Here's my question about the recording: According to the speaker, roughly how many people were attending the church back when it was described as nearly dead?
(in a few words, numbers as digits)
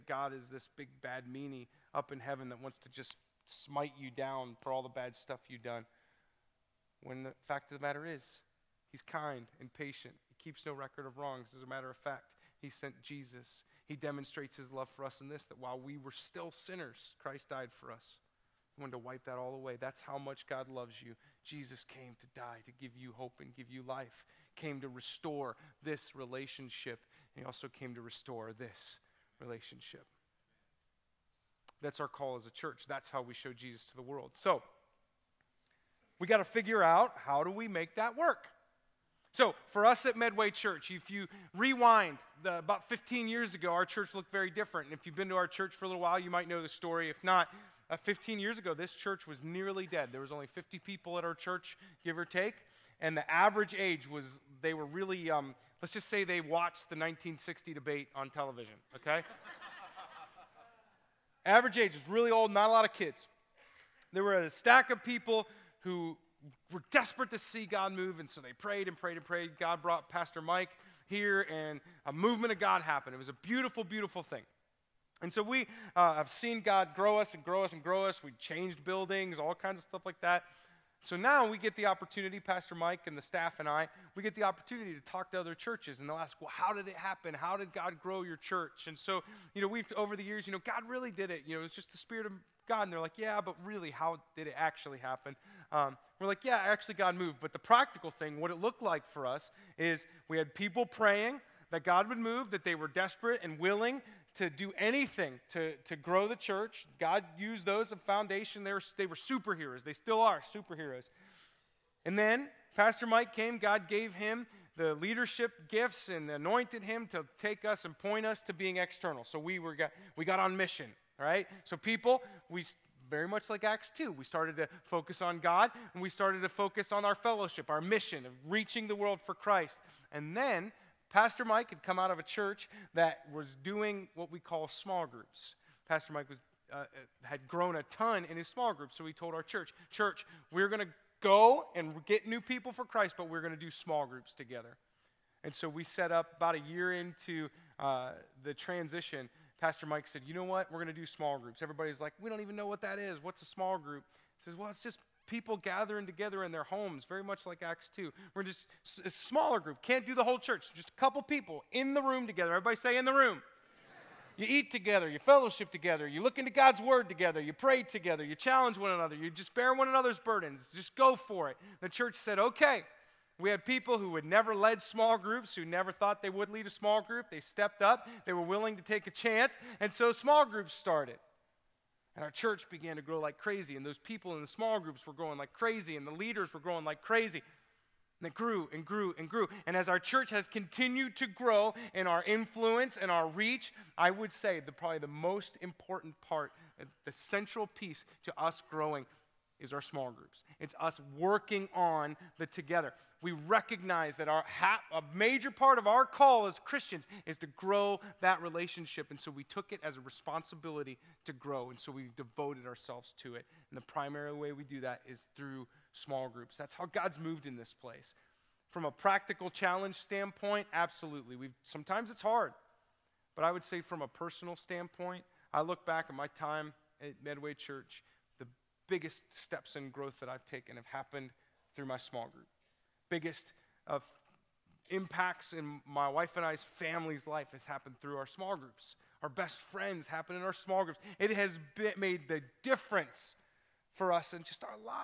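50.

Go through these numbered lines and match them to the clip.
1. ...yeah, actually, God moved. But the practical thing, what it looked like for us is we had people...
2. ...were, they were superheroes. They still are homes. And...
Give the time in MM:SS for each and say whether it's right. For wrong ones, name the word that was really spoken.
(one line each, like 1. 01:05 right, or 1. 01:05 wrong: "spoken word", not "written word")
1. 01:36 right
2. 01:48 wrong: "superheroes", not "homes".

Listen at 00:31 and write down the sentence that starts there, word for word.
That's our call as a church.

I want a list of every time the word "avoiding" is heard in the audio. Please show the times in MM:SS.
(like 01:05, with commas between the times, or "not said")
not said.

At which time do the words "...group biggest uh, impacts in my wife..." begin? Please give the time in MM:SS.
03:52.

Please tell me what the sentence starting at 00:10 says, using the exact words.
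He keeps no record of wrongs.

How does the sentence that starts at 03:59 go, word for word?
Our best friends happen in our small groups.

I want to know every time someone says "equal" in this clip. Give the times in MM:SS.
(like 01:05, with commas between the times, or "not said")
not said.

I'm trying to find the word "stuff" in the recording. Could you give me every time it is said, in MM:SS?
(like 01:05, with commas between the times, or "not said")
00:05, 01:19.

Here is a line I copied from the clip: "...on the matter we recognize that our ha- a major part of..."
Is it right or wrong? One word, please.
wrong.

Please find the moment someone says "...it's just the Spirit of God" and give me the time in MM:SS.
01:31.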